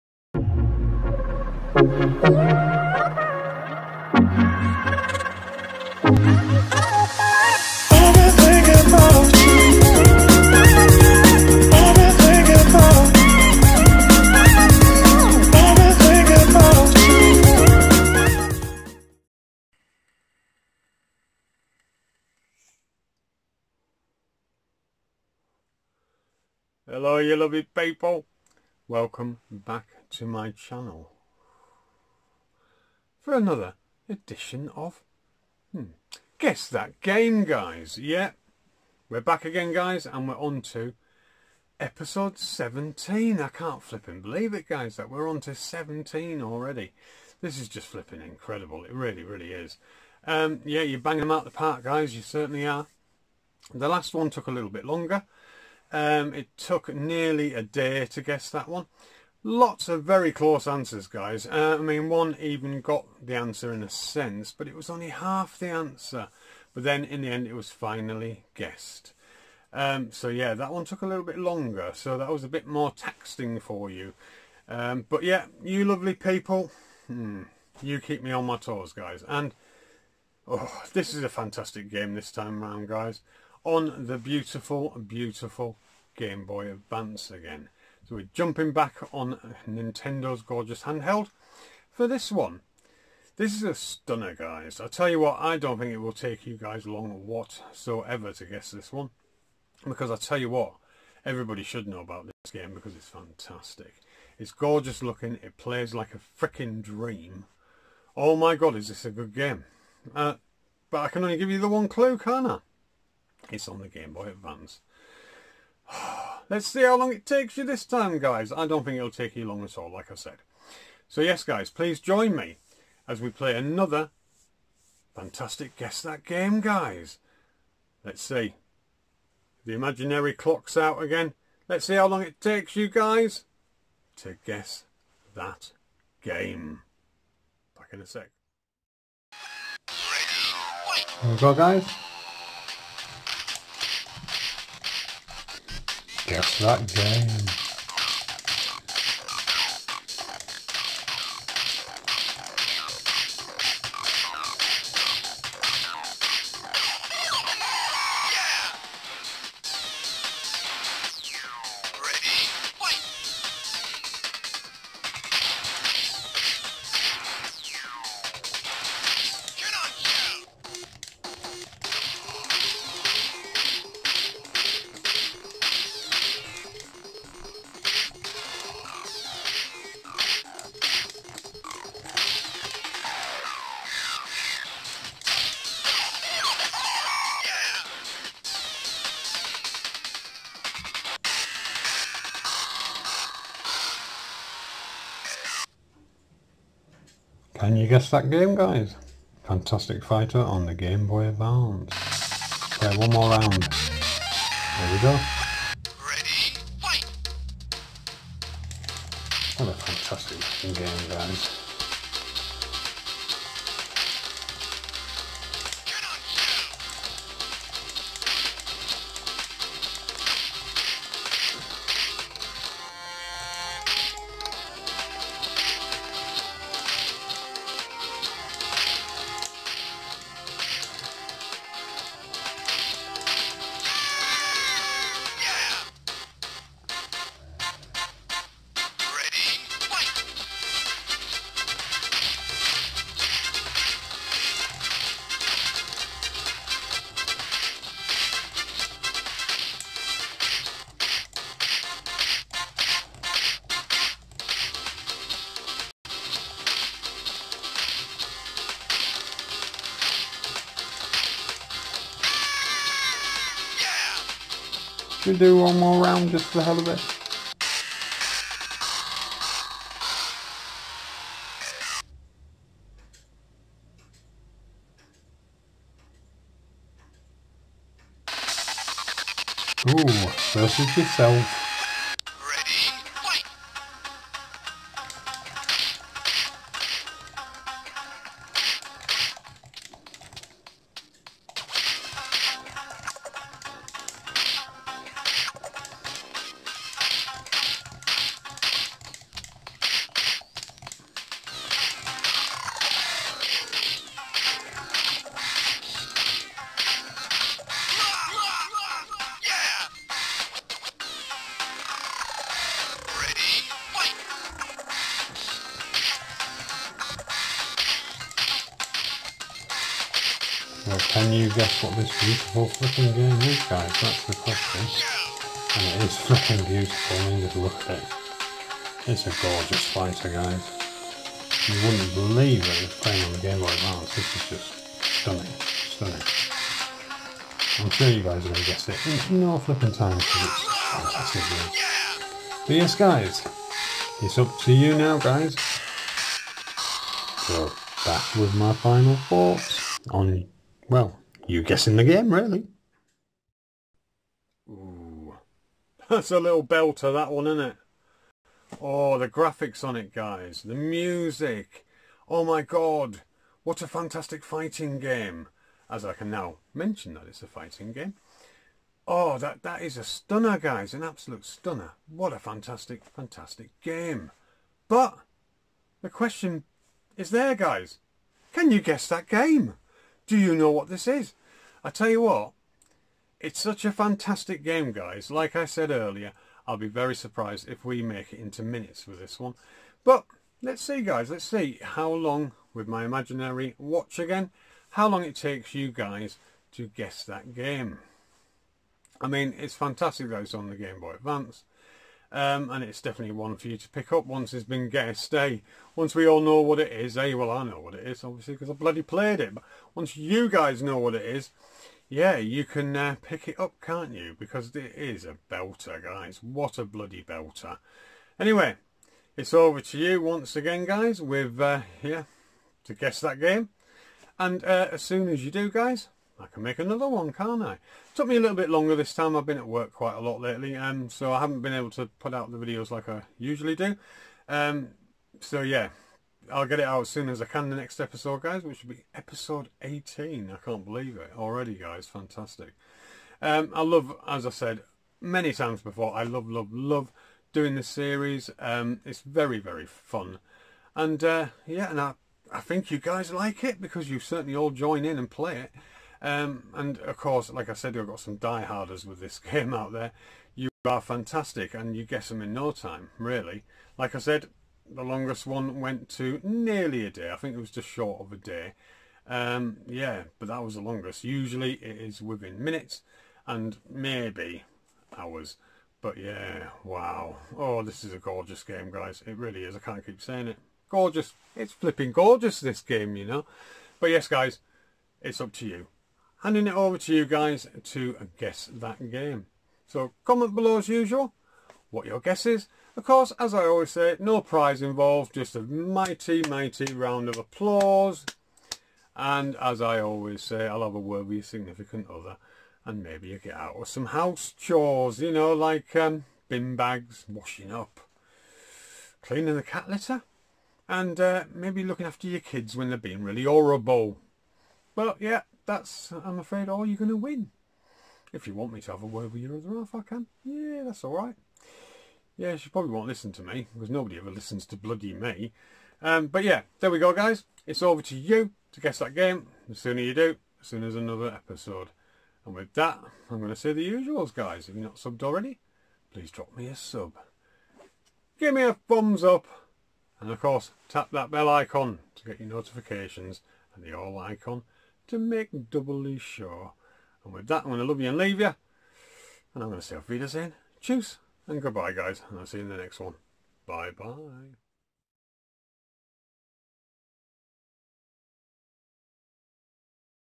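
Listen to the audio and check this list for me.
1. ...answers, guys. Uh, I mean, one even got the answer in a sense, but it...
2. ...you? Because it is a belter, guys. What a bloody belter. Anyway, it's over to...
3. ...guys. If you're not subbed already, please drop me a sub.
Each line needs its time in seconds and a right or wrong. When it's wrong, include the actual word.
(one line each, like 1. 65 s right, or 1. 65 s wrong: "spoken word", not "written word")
1. 60 s right
2. 414 s right
3. 534 s right.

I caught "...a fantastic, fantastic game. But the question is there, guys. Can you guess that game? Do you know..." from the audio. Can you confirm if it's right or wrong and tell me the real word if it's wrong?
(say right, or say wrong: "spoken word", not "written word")
right.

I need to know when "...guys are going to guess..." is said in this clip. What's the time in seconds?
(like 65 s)
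338 s.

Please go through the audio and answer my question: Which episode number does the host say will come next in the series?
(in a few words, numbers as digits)
18.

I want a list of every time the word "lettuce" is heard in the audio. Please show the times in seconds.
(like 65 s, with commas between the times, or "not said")
not said.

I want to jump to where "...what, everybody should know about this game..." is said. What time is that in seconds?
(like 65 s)
100 s.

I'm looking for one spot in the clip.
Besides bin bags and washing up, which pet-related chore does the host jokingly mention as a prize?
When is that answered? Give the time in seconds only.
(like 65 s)
509 s.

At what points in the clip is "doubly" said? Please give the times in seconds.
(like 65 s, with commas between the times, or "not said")
545 s.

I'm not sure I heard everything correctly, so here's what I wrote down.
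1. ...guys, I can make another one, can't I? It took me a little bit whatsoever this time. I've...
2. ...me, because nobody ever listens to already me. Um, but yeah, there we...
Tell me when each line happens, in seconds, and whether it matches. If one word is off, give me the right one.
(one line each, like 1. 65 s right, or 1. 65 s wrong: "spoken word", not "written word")
1. 425 s wrong: "longer", not "whatsoever"
2. 523 s wrong: "bloody", not "already".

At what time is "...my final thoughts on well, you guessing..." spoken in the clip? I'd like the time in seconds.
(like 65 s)
348 s.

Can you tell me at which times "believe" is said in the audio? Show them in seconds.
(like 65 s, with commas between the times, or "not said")
44 s, 332 s, 440 s.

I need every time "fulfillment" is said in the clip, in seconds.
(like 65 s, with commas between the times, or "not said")
not said.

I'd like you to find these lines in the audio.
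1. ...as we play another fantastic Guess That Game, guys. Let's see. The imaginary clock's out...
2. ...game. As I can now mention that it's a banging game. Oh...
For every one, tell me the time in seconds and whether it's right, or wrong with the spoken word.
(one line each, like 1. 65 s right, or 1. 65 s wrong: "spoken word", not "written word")
1. 123 s right
2. 364 s wrong: "fighting", not "banging".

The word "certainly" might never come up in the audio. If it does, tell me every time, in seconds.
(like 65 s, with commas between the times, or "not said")
52 s, 454 s.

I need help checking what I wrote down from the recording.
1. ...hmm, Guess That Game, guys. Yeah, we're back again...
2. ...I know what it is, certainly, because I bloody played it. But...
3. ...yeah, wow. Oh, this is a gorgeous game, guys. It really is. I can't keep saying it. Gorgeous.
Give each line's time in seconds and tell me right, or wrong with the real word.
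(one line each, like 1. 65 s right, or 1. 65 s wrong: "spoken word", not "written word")
1. 35 s right
2. 407 s wrong: "obviously", not "certainly"
3. 476 s right.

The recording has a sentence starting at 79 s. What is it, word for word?
And oh, this is a fantastic game this time round, guys.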